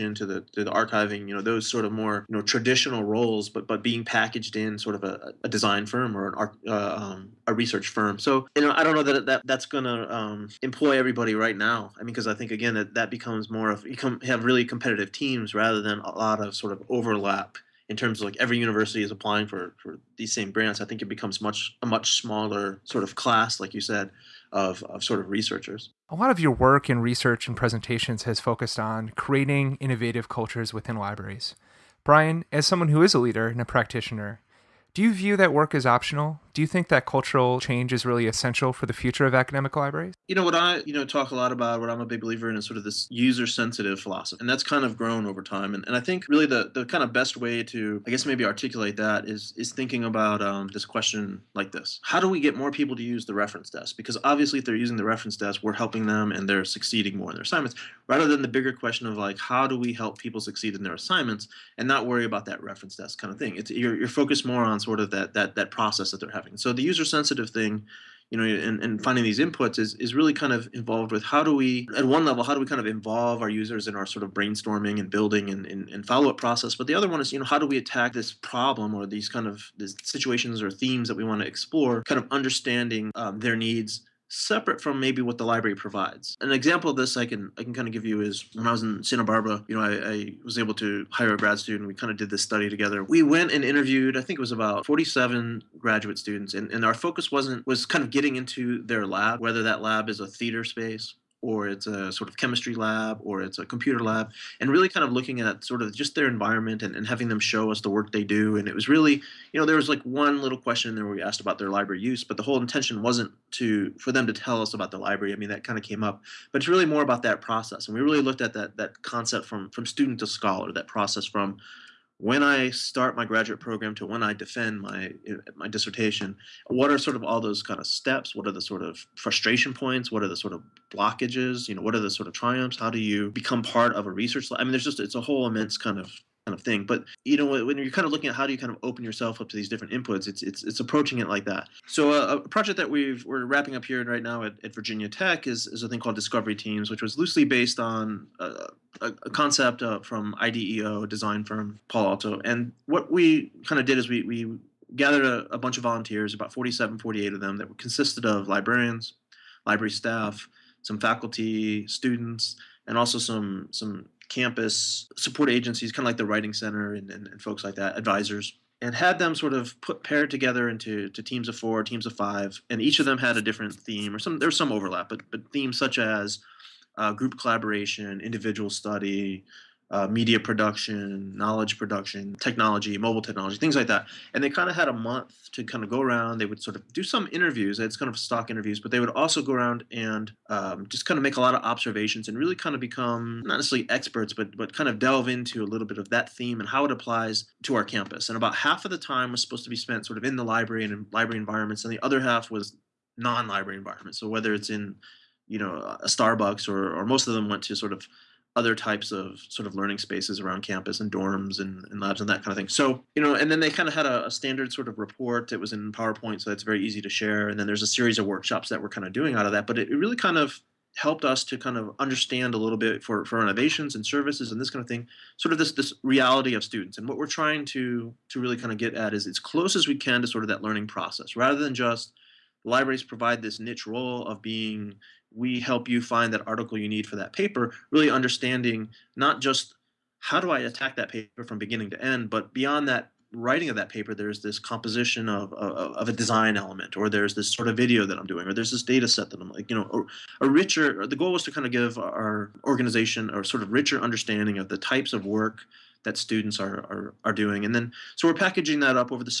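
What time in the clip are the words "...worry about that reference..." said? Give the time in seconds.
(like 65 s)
62 s.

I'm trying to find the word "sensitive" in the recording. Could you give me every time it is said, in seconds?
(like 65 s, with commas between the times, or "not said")
43 s, 67 s.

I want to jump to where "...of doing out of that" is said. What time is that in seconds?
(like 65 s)
219 s.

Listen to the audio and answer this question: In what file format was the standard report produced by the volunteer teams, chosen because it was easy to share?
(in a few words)
PowerPoint.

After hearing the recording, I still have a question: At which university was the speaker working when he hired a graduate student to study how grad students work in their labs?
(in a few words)
Santa Barbara.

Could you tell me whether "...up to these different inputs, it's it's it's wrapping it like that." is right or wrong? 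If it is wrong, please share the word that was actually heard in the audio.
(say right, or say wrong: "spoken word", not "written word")
wrong: "approaching", not "wrapping".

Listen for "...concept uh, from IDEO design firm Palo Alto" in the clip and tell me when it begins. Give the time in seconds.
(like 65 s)
149 s.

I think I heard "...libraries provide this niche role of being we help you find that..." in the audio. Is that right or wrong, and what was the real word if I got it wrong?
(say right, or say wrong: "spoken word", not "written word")
right.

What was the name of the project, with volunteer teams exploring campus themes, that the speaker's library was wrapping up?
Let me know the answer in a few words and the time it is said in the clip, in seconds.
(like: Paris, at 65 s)
Discovery Teams, at 146 s.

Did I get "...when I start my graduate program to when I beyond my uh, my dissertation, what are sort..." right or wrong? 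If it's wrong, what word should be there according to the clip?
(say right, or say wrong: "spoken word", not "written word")
wrong: "defend", not "beyond".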